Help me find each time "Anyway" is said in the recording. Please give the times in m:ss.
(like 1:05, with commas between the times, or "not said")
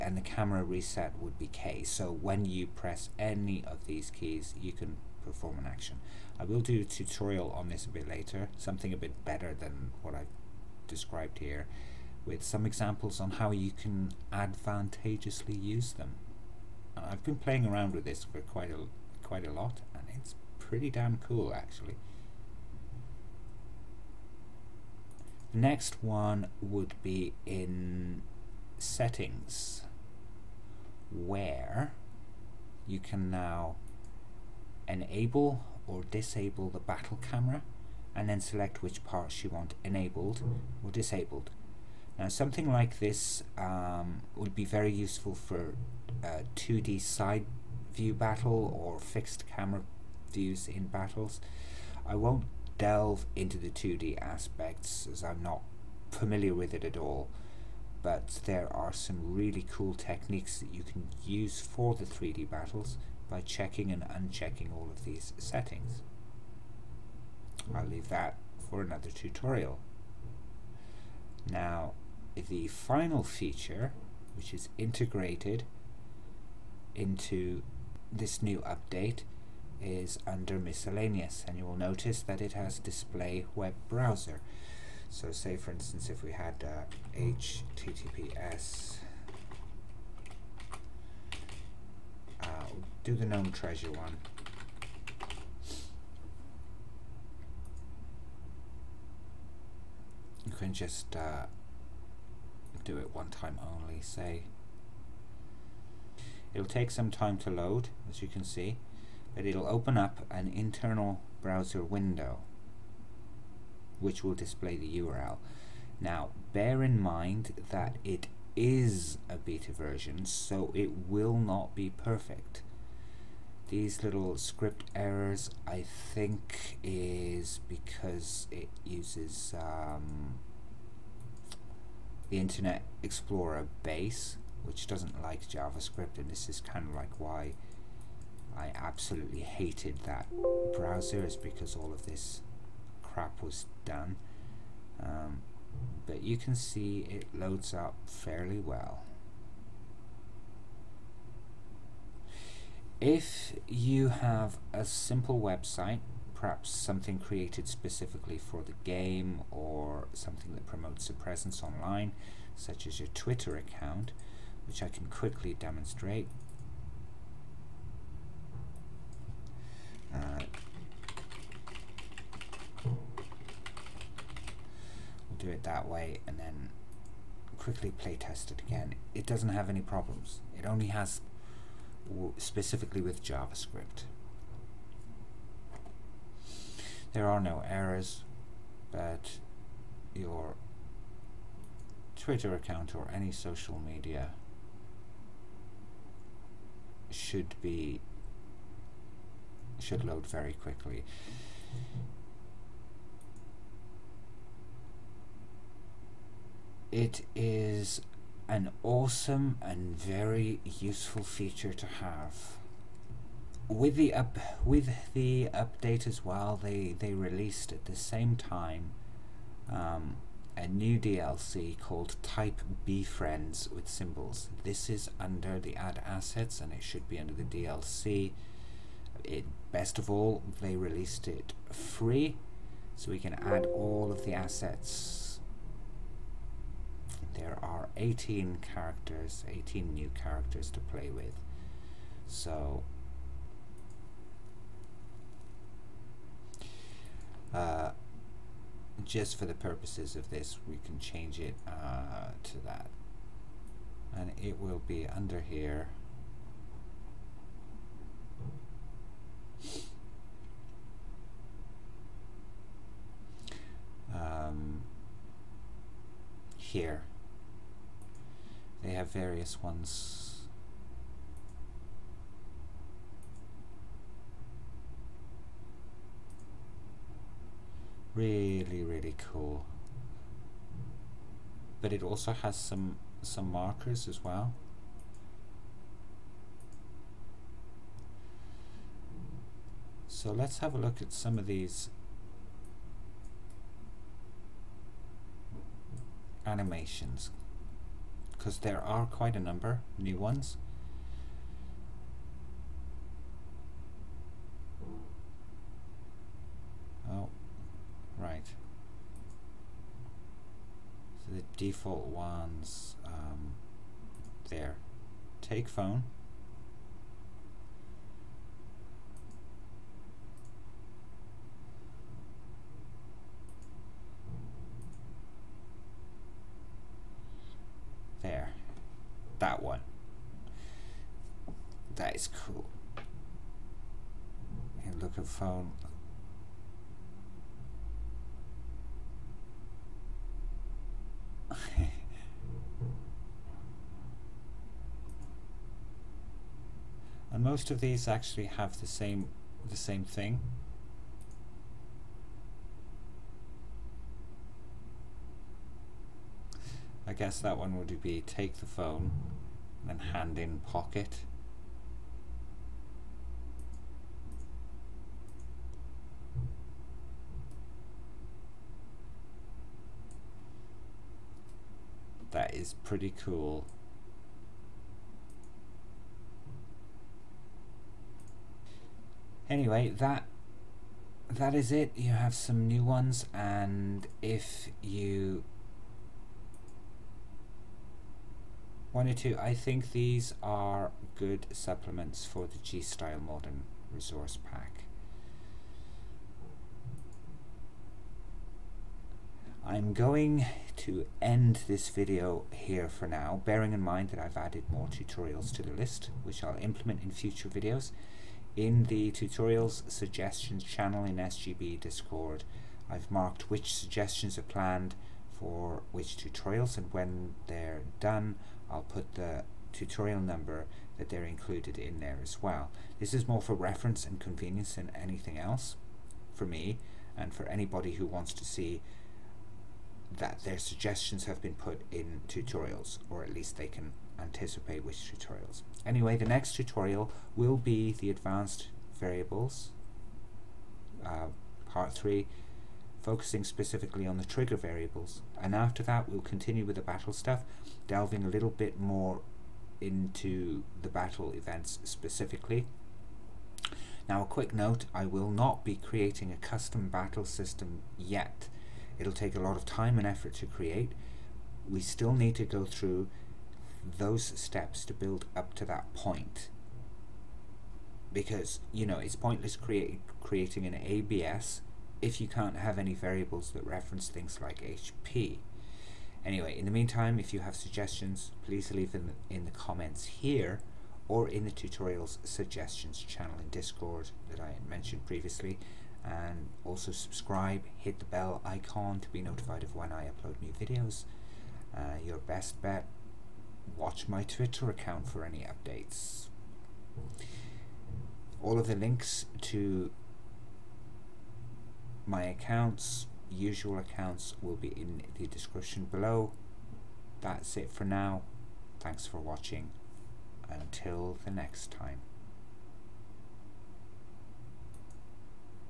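6:19, 7:15, 7:56.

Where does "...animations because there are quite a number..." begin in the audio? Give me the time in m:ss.
4:56.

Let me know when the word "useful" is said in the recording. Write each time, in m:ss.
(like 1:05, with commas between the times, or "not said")
0:44, 3:30.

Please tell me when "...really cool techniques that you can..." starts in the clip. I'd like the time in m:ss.
0:59.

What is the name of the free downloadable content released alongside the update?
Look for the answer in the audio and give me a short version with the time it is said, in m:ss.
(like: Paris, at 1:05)
Type B Friends, at 3:42.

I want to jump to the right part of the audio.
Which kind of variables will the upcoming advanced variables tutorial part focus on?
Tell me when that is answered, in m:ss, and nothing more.
7:24.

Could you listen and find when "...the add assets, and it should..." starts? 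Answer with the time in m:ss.
3:45.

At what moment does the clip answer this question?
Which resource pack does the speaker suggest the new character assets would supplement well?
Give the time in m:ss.
6:32.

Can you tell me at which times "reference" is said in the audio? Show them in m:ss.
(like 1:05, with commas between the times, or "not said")
7:03, 7:53.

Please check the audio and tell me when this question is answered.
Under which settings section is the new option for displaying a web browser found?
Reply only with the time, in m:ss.
1:20.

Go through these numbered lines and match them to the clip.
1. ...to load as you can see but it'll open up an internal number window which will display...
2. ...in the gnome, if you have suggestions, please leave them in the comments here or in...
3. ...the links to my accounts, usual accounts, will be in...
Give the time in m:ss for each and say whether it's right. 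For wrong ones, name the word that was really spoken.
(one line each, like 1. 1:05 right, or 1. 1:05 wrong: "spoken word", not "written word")
1. 1:47 wrong: "browser", not "number"
2. 7:56 wrong: "meantime", not "gnome"
3. 8:18 right.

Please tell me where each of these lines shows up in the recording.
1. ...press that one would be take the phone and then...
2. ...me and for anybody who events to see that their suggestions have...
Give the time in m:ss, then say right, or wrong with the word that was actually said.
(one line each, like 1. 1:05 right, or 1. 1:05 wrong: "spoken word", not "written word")
1. 5:57 wrong: "guess", not "press"
2. 7:06 wrong: "wants", not "events".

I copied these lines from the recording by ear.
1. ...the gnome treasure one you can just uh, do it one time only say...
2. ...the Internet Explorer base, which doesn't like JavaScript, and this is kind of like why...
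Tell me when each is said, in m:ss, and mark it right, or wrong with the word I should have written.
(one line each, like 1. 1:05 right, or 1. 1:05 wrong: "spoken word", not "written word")
1. 1:33 right
2. 2:12 right.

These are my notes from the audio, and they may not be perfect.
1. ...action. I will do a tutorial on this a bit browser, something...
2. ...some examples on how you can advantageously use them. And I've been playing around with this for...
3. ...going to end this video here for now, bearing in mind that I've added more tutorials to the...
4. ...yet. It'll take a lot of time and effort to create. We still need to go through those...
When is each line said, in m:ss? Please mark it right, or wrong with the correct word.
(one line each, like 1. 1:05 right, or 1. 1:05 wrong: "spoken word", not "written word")
1. 0:05 wrong: "later", not "browser"
2. 0:12 right
3. 6:39 right
4. 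7:37 right.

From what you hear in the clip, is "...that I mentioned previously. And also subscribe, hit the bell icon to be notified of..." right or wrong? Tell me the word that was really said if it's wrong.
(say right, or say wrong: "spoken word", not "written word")
right.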